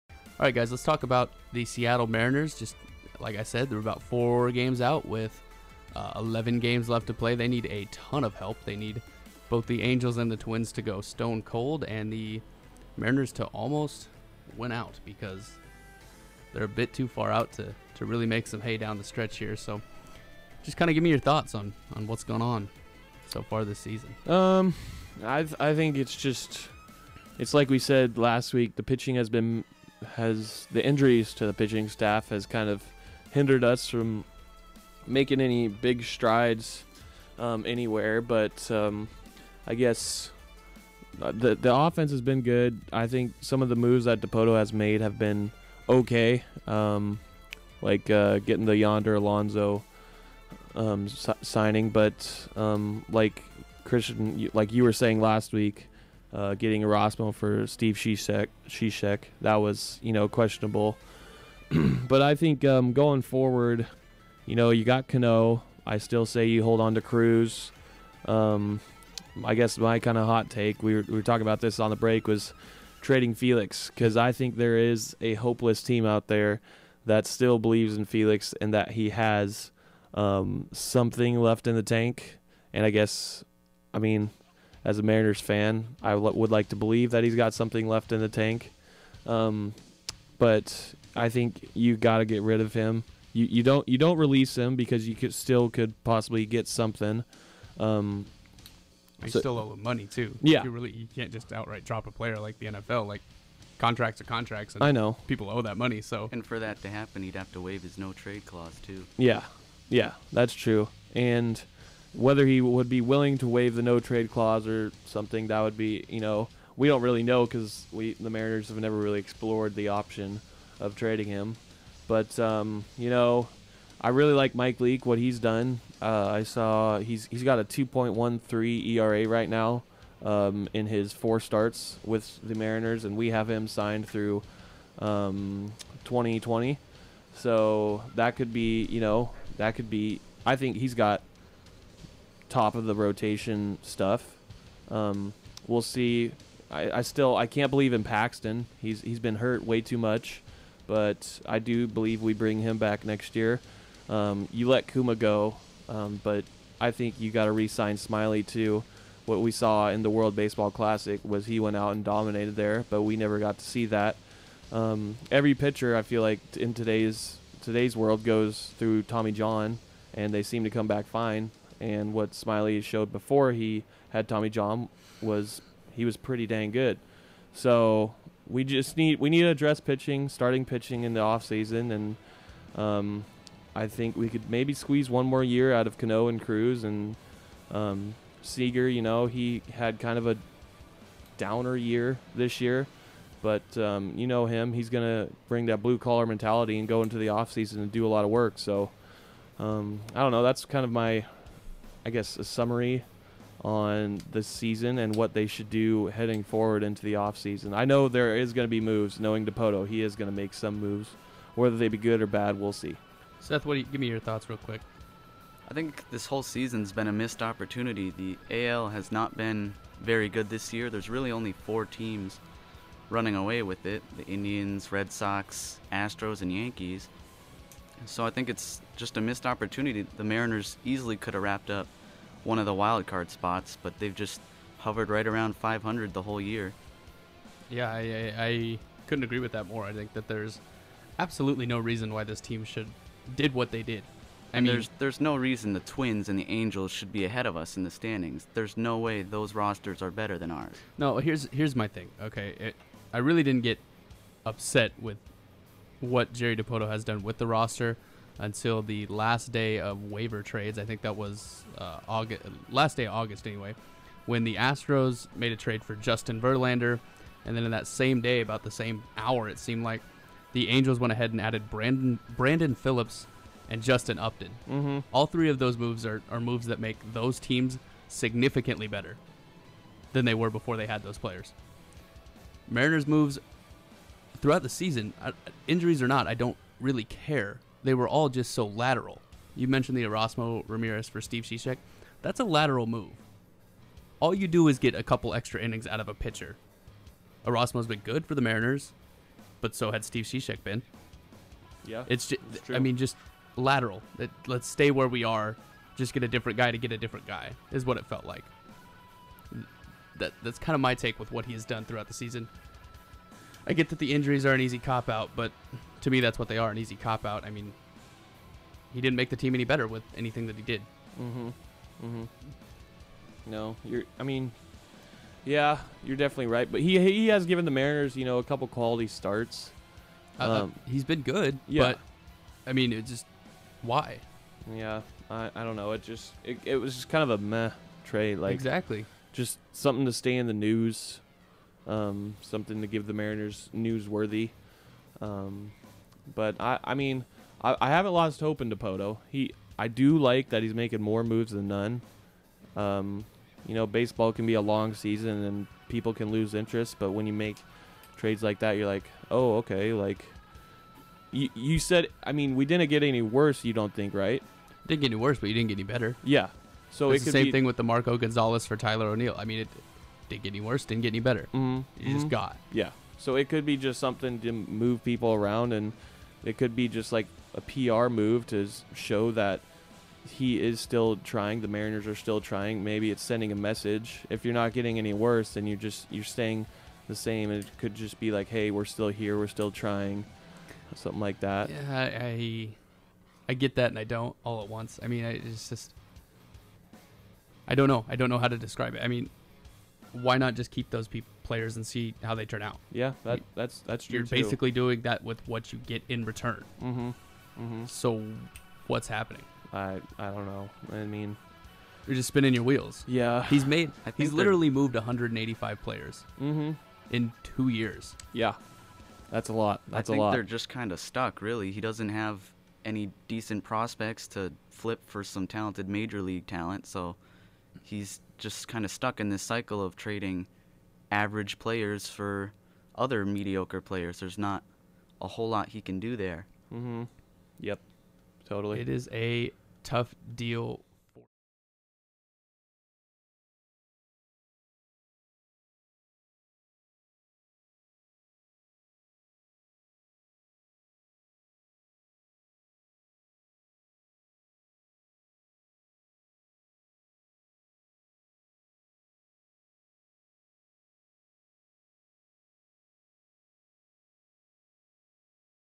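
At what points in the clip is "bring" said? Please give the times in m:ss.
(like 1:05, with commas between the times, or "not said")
2:32, 3:15.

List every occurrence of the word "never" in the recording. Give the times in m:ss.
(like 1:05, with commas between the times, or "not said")
1:58, 2:43.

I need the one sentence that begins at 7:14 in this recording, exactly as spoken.
There's not a whole lot he can do there.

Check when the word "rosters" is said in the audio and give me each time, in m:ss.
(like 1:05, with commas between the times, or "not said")
4:09, 4:17.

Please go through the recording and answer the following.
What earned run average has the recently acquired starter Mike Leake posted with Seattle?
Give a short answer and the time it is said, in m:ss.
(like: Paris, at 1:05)
2.13, at 2:07.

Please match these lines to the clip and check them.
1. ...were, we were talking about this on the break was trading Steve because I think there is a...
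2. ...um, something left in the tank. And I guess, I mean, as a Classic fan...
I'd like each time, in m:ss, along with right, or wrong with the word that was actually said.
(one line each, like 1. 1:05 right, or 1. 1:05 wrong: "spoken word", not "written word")
1. 1:10 wrong: "Felix", not "Steve"
2. 1:20 wrong: "Mariners", not "Classic".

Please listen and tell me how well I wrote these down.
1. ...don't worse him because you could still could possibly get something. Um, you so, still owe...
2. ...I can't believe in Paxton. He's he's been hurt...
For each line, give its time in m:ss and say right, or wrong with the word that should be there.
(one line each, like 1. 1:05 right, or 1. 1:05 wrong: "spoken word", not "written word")
1. 1:33 wrong: "release", not "worse"
2. 2:27 right.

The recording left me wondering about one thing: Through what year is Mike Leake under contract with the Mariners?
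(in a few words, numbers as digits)
2020.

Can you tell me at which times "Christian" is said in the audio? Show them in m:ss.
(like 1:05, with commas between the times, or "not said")
0:53.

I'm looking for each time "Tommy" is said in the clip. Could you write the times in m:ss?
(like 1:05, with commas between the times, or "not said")
2:49, 2:54.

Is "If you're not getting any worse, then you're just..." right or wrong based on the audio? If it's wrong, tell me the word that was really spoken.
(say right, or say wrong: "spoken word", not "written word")
right.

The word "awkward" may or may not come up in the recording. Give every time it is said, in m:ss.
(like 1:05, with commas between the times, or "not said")
not said.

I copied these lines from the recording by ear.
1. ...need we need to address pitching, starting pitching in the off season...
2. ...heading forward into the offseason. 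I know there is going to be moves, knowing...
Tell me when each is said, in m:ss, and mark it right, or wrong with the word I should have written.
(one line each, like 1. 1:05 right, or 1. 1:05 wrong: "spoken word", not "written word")
1. 2:58 right
2. 3:26 right.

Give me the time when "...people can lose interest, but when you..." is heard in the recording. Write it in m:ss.
5:55.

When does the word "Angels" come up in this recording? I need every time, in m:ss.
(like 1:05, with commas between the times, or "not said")
0:09, 4:06, 4:30.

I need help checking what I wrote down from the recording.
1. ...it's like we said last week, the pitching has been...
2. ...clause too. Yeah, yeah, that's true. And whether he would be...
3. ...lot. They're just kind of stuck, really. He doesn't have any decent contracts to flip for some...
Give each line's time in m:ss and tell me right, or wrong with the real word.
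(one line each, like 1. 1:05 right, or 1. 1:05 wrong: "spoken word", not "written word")
1. 0:27 right
2. 1:48 right
3. 7:00 wrong: "prospects", not "contracts".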